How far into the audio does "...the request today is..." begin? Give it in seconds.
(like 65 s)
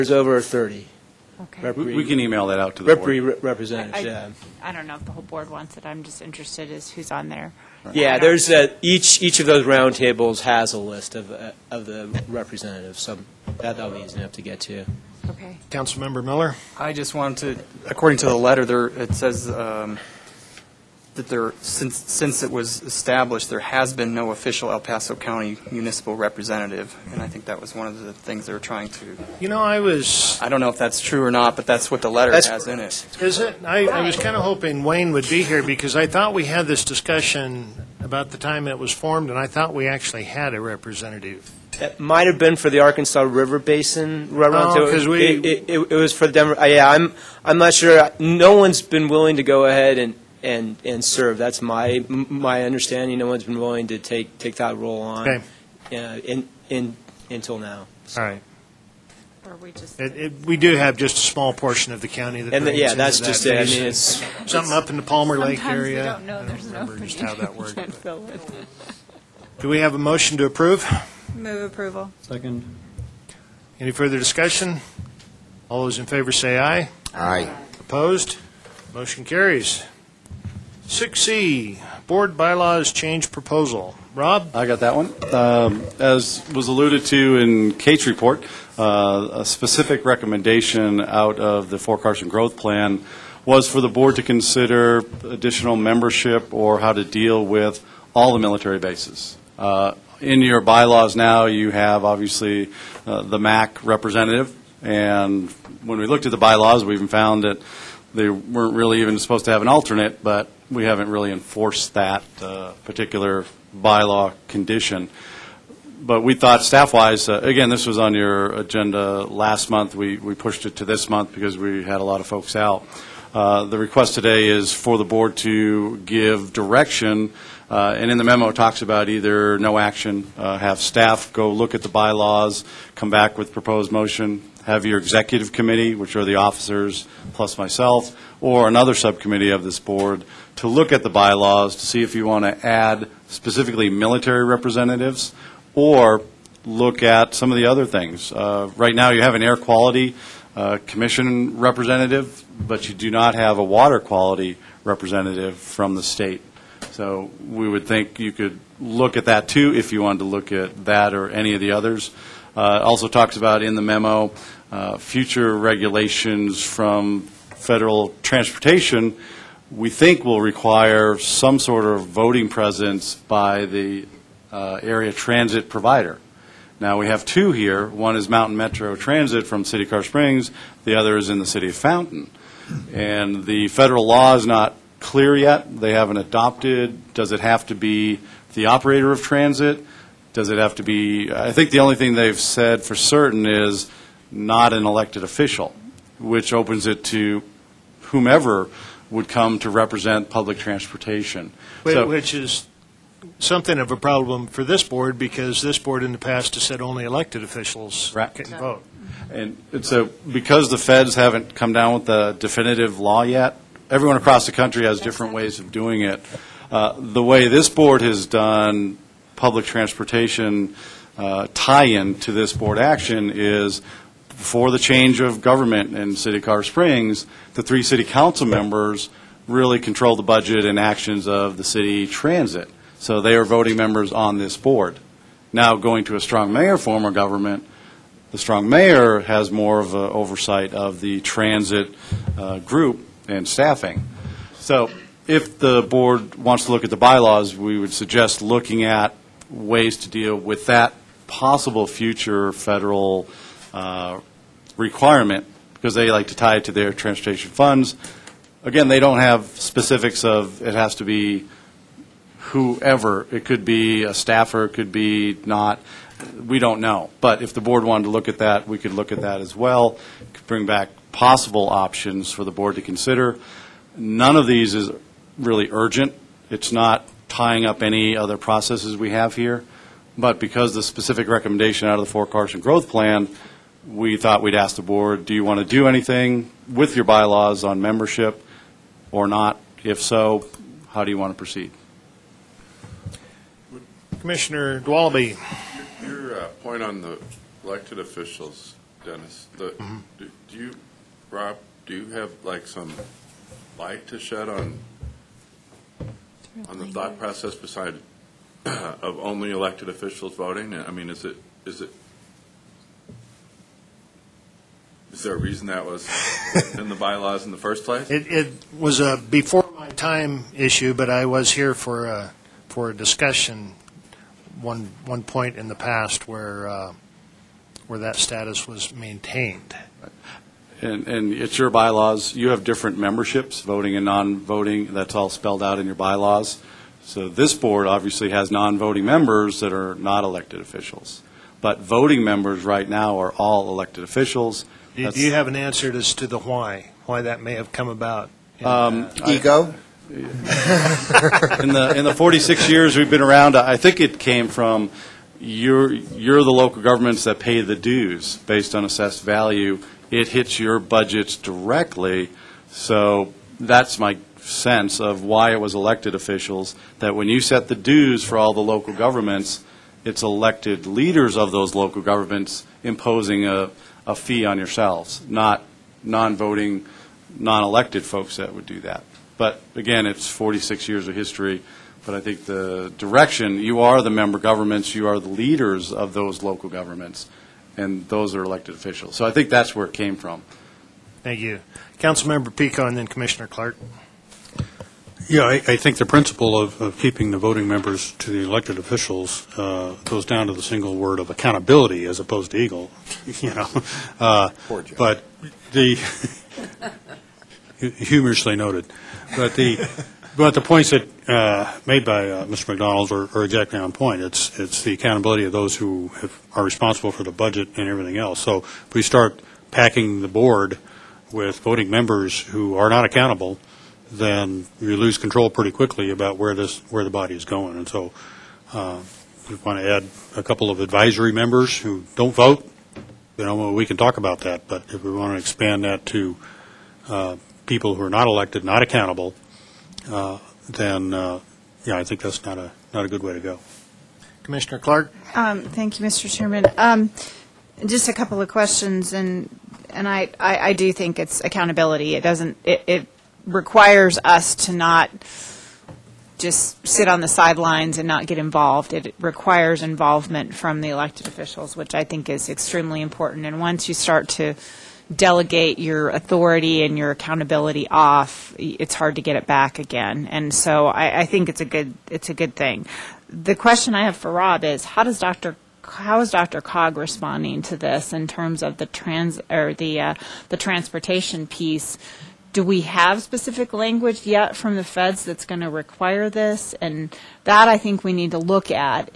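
123 s.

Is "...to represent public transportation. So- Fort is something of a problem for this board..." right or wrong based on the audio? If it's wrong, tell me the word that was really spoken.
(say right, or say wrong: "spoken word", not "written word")
wrong: "Which", not "Fort".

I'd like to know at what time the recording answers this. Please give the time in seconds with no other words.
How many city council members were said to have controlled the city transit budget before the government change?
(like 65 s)
227 s.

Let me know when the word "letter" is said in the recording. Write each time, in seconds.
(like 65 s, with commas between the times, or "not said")
18 s, 32 s.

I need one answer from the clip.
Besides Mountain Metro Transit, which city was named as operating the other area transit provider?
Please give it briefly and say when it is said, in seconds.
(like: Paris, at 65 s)
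Fountain, at 181 s.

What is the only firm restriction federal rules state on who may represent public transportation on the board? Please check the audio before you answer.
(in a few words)
not an elected official.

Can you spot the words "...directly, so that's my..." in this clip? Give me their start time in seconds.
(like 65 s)
361 s.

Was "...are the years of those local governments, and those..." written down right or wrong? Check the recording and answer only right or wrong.
wrong.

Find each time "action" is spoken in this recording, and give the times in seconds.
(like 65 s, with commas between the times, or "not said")
129 s, 222 s, 230 s.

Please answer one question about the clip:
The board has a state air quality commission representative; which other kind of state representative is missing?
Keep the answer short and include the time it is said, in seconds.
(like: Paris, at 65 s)
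water quality, at 153 s.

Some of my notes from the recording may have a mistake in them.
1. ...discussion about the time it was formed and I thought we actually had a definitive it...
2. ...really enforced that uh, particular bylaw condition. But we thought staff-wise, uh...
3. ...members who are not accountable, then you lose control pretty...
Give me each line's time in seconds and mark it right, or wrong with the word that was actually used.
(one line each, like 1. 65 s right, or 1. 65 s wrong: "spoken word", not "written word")
1. 36 s wrong: "representative", not "definitive"
2. 111 s right
3. 421 s right.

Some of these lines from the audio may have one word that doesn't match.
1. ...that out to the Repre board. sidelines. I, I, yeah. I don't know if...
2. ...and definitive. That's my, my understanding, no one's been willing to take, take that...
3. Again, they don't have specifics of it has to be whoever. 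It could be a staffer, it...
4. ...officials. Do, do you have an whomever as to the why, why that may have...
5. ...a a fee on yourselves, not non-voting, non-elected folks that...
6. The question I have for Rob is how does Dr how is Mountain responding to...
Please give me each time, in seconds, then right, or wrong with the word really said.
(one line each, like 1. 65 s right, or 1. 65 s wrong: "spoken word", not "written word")
1. 2 s wrong: "representatives", not "sidelines"
2. 50 s wrong: "serve", not "definitive"
3. 258 s right
4. 344 s wrong: "answer", not "whomever"
5. 373 s right
6. 473 s wrong: "DRCOG", not "Mountain".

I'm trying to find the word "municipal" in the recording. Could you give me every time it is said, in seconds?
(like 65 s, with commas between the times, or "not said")
25 s.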